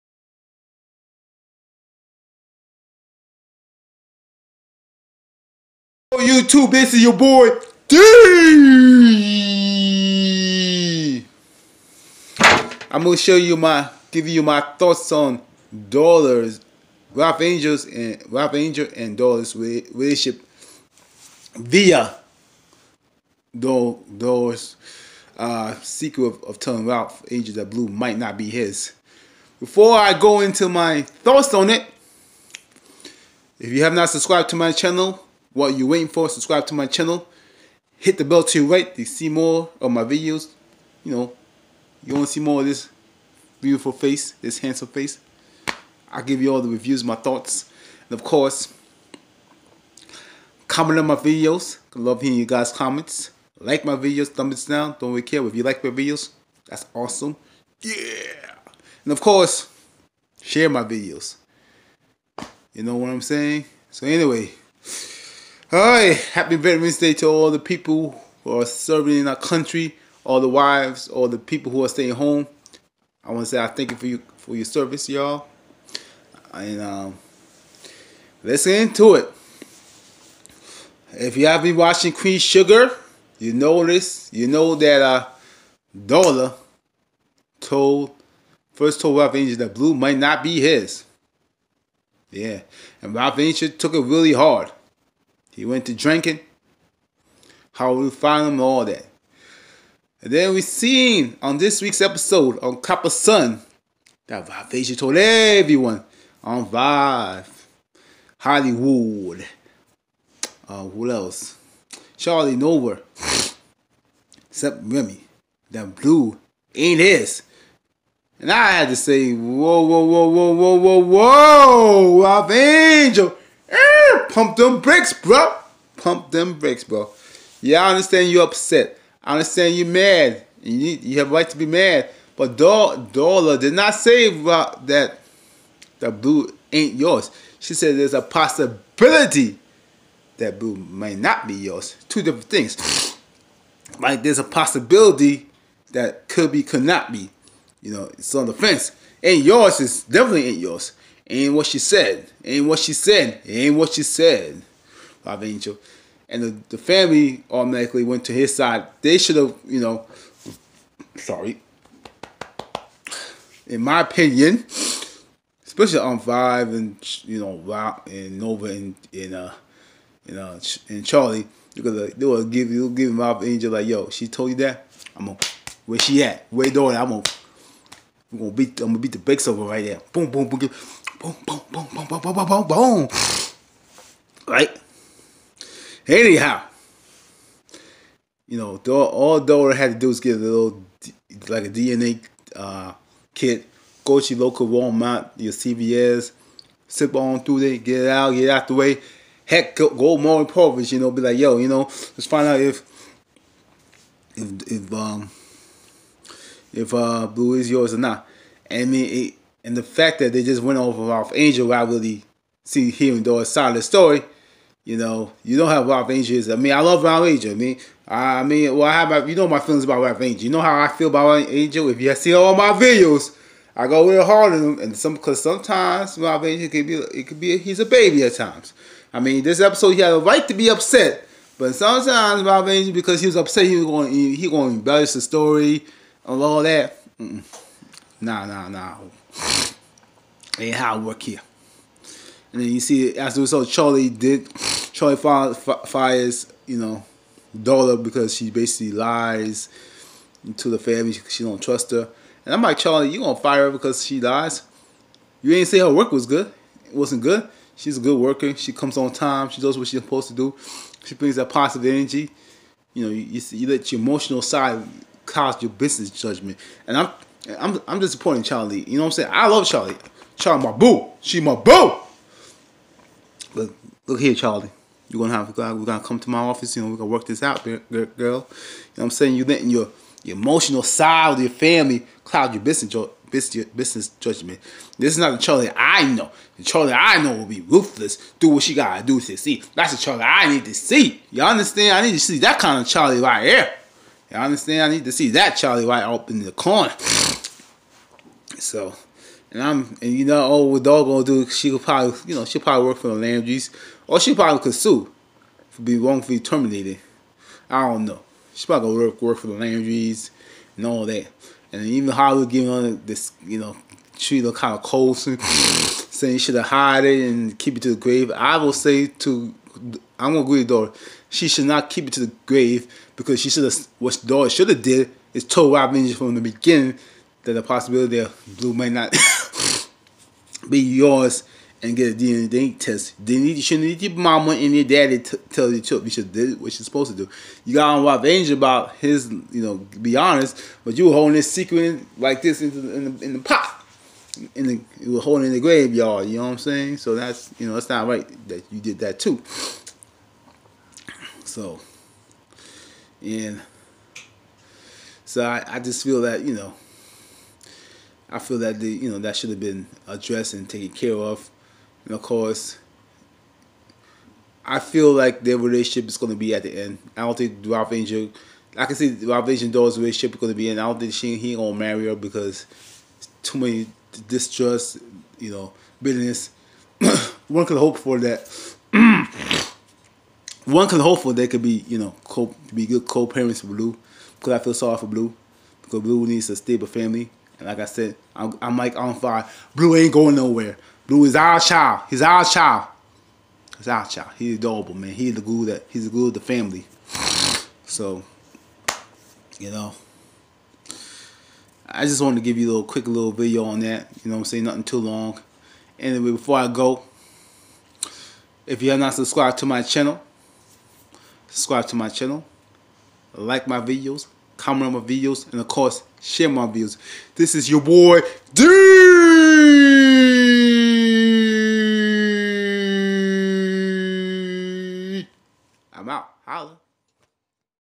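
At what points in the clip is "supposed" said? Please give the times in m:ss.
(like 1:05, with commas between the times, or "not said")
4:20, 5:36.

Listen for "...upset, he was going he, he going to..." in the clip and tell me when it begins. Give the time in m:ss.
3:53.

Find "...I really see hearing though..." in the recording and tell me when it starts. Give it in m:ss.
3:31.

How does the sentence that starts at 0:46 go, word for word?
I'll give you all the reviews, my thoughts.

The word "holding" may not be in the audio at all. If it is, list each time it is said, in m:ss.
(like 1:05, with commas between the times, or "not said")
5:41, 5:45.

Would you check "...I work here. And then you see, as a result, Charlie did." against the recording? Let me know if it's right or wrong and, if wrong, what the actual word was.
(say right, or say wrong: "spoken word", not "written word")
right.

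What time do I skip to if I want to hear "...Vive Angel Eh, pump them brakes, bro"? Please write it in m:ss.
2:02.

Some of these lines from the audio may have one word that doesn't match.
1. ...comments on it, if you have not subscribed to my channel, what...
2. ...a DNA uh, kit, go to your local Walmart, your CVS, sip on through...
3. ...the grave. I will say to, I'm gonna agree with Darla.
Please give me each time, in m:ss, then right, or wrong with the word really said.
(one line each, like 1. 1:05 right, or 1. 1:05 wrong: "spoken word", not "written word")
1. 0:31 wrong: "thoughts", not "comments"
2. 3:11 right
3. 5:17 right.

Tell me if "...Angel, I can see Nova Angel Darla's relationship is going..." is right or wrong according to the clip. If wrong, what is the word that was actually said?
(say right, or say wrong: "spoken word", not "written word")
wrong: "Ralph", not "Nova".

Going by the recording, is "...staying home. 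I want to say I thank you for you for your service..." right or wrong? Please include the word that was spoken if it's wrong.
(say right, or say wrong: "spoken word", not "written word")
right.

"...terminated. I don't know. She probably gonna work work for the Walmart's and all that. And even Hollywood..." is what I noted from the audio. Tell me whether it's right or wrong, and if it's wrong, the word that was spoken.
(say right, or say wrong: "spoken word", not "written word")
wrong: "Landry", not "Walmart".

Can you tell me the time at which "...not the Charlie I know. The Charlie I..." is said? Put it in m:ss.
4:45.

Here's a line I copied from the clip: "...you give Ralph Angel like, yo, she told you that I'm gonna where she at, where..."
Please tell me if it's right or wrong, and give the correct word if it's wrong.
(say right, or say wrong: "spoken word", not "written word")
right.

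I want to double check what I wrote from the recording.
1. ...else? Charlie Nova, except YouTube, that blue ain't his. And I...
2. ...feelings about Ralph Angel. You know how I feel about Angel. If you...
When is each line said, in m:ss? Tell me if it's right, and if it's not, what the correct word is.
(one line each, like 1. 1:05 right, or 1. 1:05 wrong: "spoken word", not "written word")
1. 1:51 wrong: "Remy", not "YouTube"
2. 3:39 right.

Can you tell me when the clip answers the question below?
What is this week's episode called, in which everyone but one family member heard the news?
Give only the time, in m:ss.
1:42.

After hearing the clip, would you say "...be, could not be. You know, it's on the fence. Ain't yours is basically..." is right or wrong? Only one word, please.
wrong.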